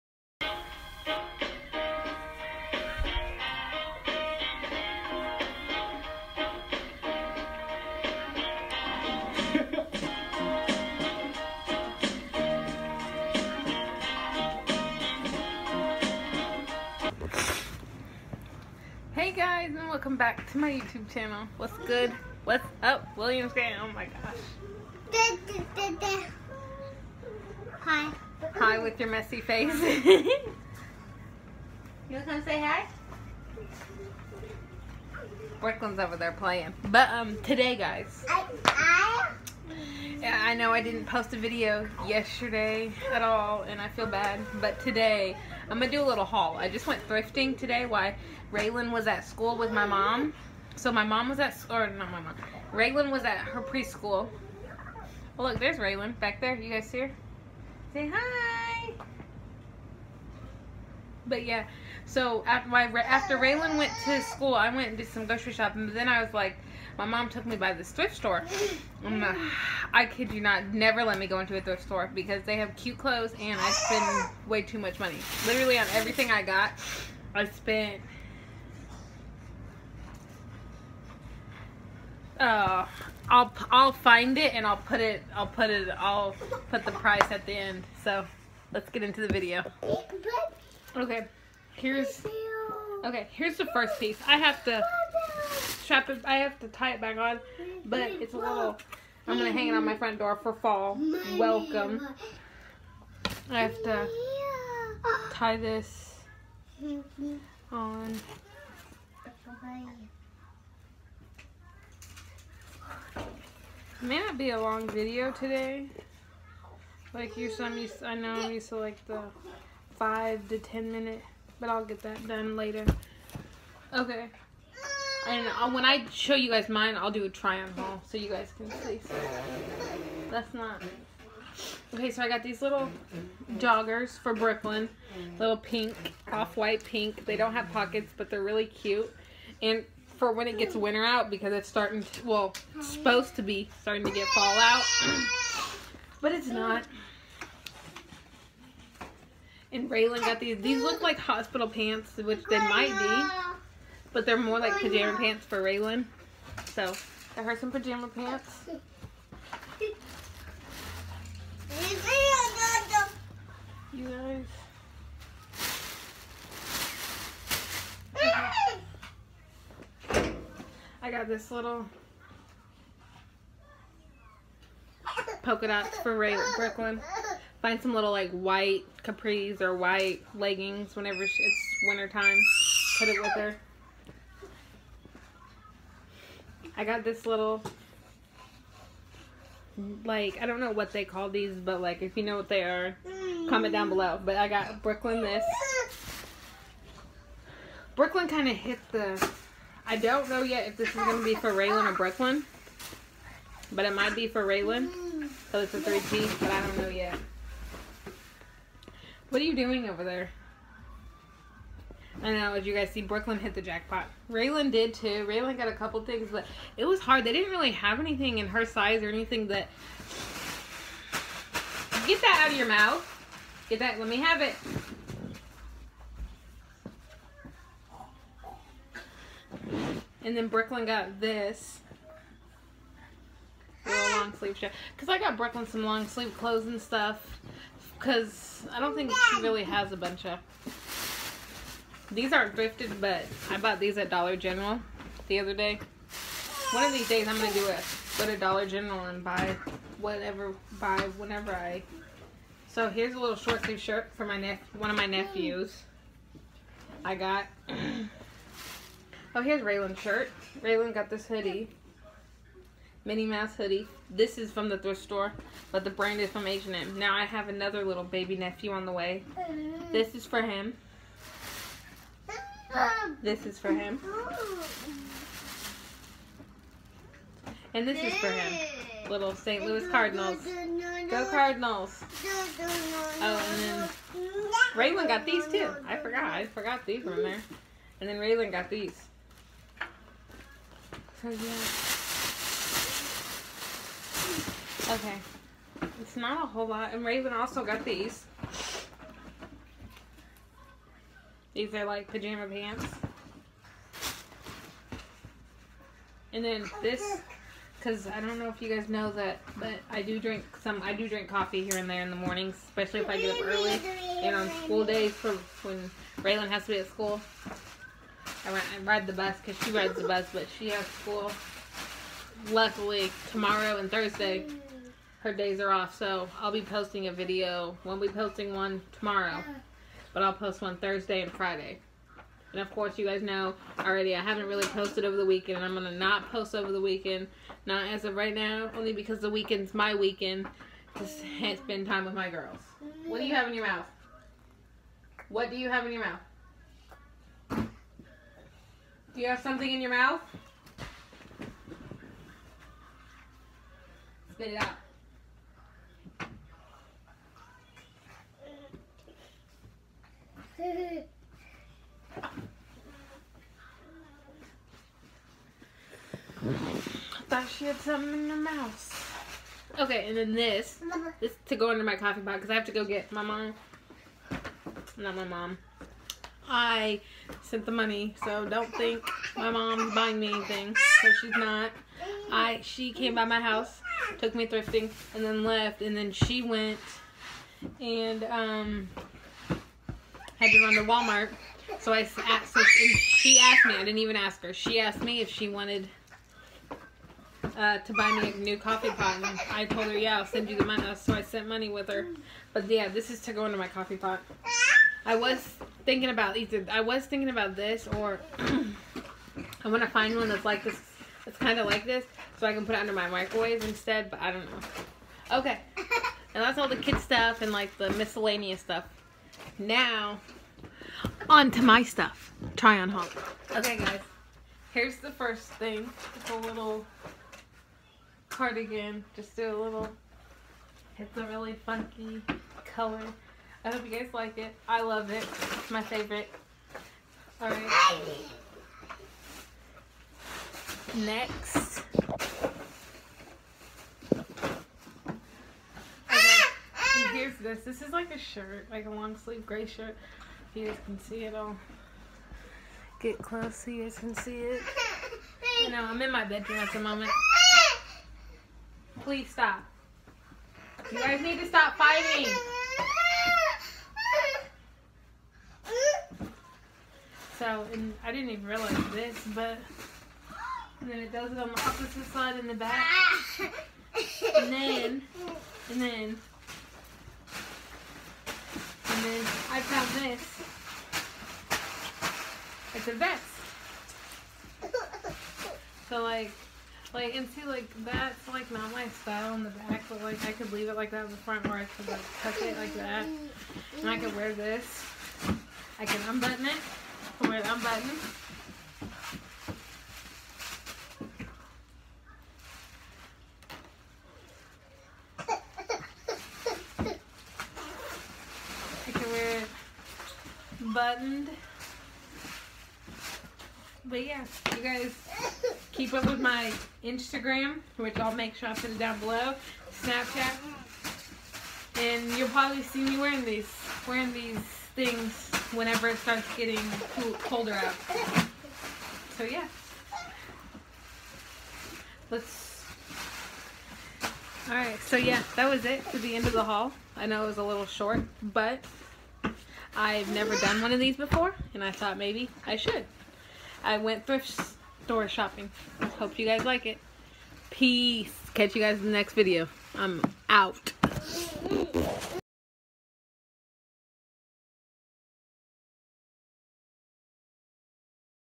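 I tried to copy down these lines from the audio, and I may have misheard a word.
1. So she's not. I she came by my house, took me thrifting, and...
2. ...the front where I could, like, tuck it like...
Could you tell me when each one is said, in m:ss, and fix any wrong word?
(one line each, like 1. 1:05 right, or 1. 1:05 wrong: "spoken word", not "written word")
1. 6:21 right
2. 8:11 right.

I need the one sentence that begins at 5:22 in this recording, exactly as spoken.
Luckily, tomorrow and Thursday, her days are off, so I'll be posting a video.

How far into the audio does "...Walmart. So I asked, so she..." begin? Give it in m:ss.
6:30.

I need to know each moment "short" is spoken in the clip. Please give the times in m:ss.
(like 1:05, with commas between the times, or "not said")
4:13, 8:57.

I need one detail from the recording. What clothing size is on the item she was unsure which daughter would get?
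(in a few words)
3T.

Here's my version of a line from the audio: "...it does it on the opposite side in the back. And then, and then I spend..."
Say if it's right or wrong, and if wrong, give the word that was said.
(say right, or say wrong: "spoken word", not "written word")
wrong: "found", not "spend".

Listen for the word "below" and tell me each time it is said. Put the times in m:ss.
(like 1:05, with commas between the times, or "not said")
3:13, 8:38.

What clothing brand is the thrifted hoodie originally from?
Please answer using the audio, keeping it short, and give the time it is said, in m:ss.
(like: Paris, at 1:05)
H&M, at 4:26.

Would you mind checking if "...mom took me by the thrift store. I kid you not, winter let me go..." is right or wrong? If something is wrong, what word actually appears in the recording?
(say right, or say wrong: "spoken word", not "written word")
wrong: "never", not "winter".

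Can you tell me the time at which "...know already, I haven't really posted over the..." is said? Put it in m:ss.
5:33.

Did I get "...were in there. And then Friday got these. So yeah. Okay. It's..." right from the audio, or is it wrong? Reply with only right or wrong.
wrong.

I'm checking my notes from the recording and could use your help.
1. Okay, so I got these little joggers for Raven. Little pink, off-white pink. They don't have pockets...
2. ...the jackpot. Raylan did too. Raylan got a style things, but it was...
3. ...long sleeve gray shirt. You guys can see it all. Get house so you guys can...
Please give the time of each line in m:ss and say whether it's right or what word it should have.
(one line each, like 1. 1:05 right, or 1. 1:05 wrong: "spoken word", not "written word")
1. 2:11 wrong: "Brooklyn", not "Raven"
2. 3:33 wrong: "couple", not "style"
3. 7:28 wrong: "close", not "house".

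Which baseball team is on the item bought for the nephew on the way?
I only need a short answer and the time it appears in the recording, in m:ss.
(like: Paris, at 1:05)
St. Louis Cardinals, at 4:39.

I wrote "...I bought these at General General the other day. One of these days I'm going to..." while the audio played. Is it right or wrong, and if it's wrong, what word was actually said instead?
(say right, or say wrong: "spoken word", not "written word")
wrong: "Dollar", not "General".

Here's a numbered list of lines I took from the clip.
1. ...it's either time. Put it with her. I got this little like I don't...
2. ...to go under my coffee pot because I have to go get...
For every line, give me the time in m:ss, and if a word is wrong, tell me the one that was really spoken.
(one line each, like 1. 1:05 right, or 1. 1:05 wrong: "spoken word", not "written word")
1. 3:01 wrong: "winter", not "either"
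2. 6:11 right.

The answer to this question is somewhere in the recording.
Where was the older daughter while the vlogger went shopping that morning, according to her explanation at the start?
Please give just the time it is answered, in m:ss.
0:53.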